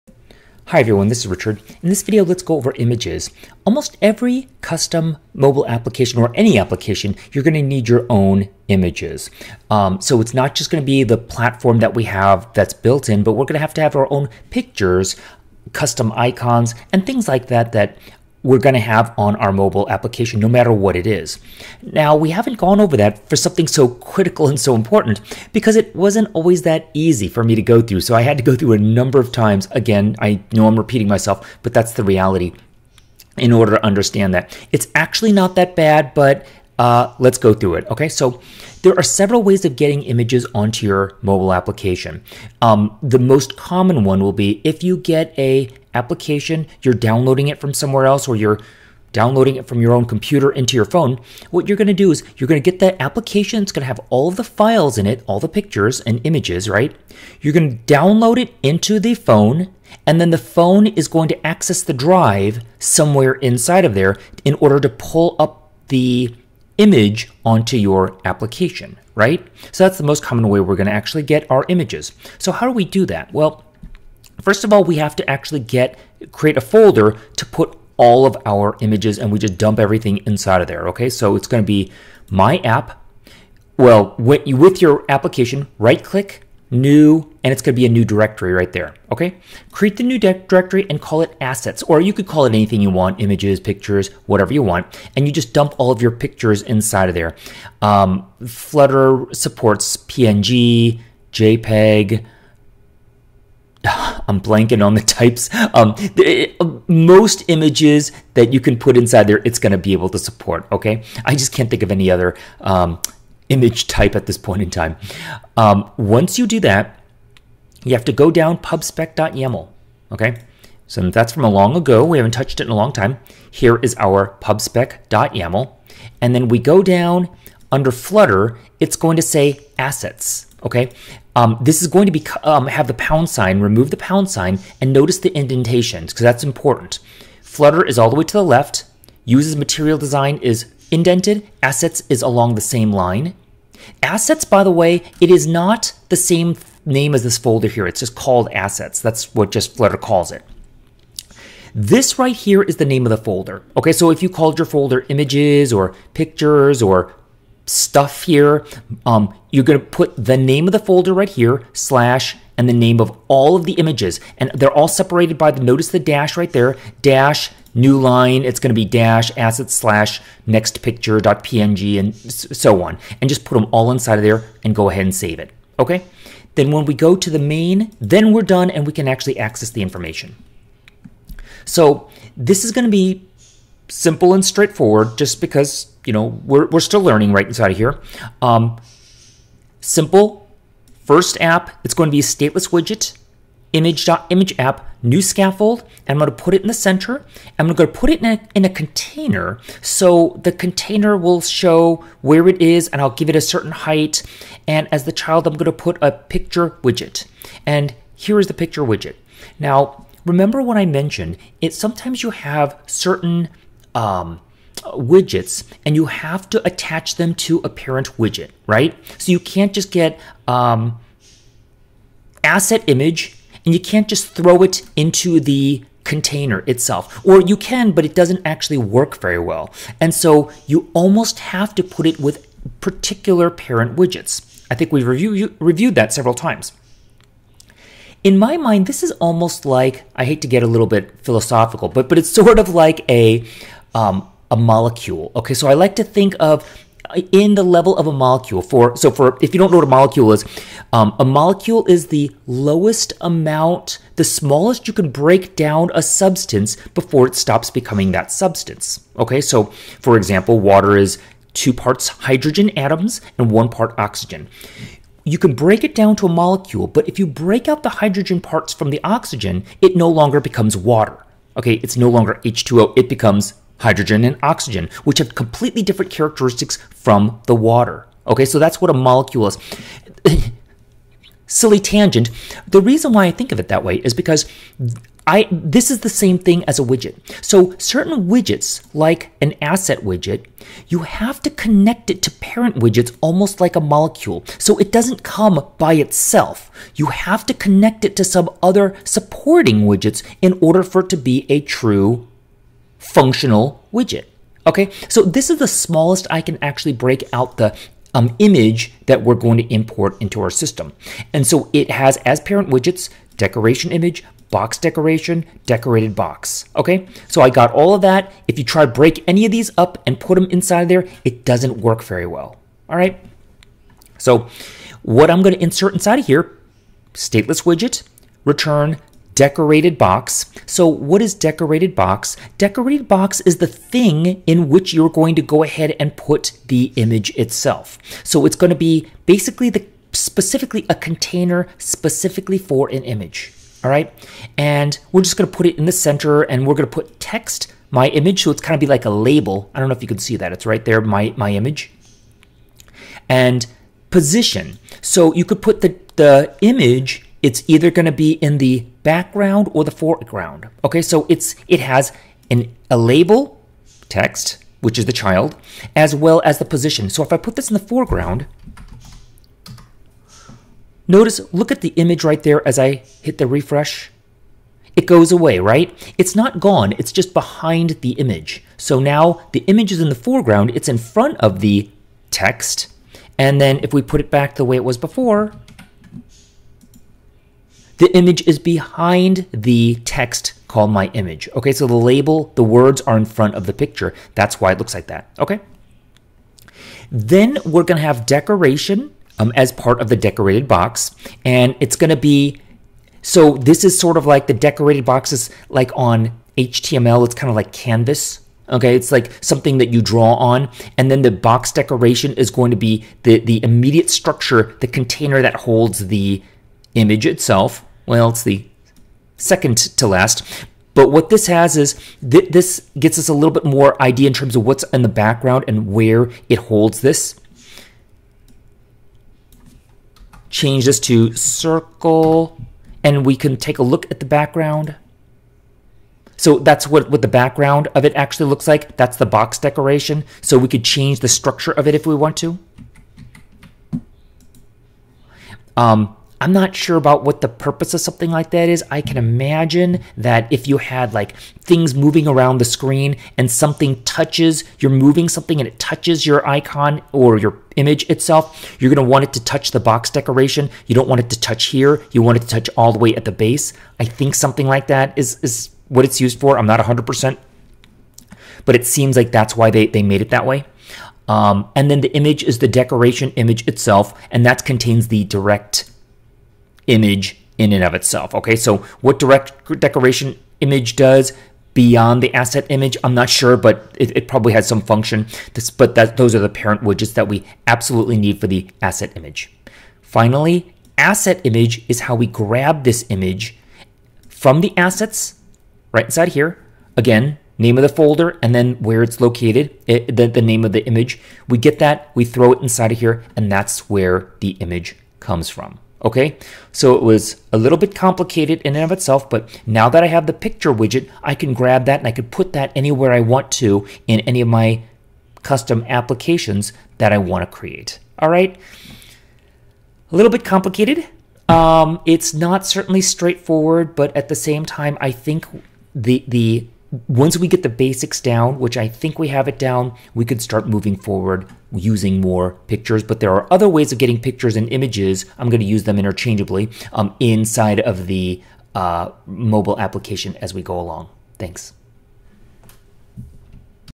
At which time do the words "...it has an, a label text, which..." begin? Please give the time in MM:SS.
06:01.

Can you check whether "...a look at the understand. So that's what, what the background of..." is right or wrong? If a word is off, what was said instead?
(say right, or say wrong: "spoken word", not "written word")
wrong: "background", not "understand".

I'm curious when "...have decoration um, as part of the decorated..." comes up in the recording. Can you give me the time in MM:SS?
06:38.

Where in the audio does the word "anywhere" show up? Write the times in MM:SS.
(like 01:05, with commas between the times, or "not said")
08:32.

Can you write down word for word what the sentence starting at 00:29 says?
Again, I know I'm repeating myself, but that's the reality in order to understand that.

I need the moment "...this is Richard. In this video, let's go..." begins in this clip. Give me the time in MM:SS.
00:01.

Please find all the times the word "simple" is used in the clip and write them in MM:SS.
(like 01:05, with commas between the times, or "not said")
03:03, 03:09.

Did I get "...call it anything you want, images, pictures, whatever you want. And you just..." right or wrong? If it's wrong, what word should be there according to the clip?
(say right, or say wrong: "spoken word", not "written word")
right.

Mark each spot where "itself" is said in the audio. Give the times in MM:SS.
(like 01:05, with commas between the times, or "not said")
03:46, 04:55, 05:37, 06:57, 07:38, 07:53, 07:57, 08:28.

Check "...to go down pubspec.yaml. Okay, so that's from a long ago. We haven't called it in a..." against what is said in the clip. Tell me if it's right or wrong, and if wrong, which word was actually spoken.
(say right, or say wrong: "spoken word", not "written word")
wrong: "touched", not "called".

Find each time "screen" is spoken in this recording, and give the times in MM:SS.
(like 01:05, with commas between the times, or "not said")
07:32.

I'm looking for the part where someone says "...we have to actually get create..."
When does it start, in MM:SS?
01:14.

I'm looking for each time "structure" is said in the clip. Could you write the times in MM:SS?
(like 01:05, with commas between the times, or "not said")
06:54, 07:21.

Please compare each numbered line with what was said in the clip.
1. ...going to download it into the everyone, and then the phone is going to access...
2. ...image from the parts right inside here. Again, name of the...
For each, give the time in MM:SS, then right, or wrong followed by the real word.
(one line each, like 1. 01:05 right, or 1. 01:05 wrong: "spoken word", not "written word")
1. 00:57 wrong: "phone", not "everyone"
2. 08:13 wrong: "assets", not "parts".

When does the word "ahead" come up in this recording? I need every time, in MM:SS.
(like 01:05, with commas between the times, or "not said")
02:54, 05:35.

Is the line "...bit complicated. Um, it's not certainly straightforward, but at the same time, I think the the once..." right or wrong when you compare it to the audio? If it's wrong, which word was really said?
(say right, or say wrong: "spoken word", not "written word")
right.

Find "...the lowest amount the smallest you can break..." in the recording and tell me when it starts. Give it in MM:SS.
04:12.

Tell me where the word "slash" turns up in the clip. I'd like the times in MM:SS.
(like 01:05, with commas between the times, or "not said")
02:41, 02:49.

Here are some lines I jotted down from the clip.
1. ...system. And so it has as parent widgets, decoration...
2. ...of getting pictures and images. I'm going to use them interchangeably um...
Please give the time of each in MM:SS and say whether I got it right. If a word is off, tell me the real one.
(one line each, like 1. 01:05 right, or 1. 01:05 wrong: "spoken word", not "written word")
1. 05:10 right
2. 08:53 right.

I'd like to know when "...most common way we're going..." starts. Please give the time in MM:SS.
01:10.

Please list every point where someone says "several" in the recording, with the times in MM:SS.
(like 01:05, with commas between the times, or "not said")
00:39, 03:56.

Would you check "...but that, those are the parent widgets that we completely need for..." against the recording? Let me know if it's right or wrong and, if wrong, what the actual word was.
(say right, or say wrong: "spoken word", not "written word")
wrong: "absolutely", not "completely".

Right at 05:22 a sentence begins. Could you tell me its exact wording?
All right, so what I'm going to insert inside of here, stateless widget, return decorated box.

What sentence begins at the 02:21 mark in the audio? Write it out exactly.
Assets is along the same line.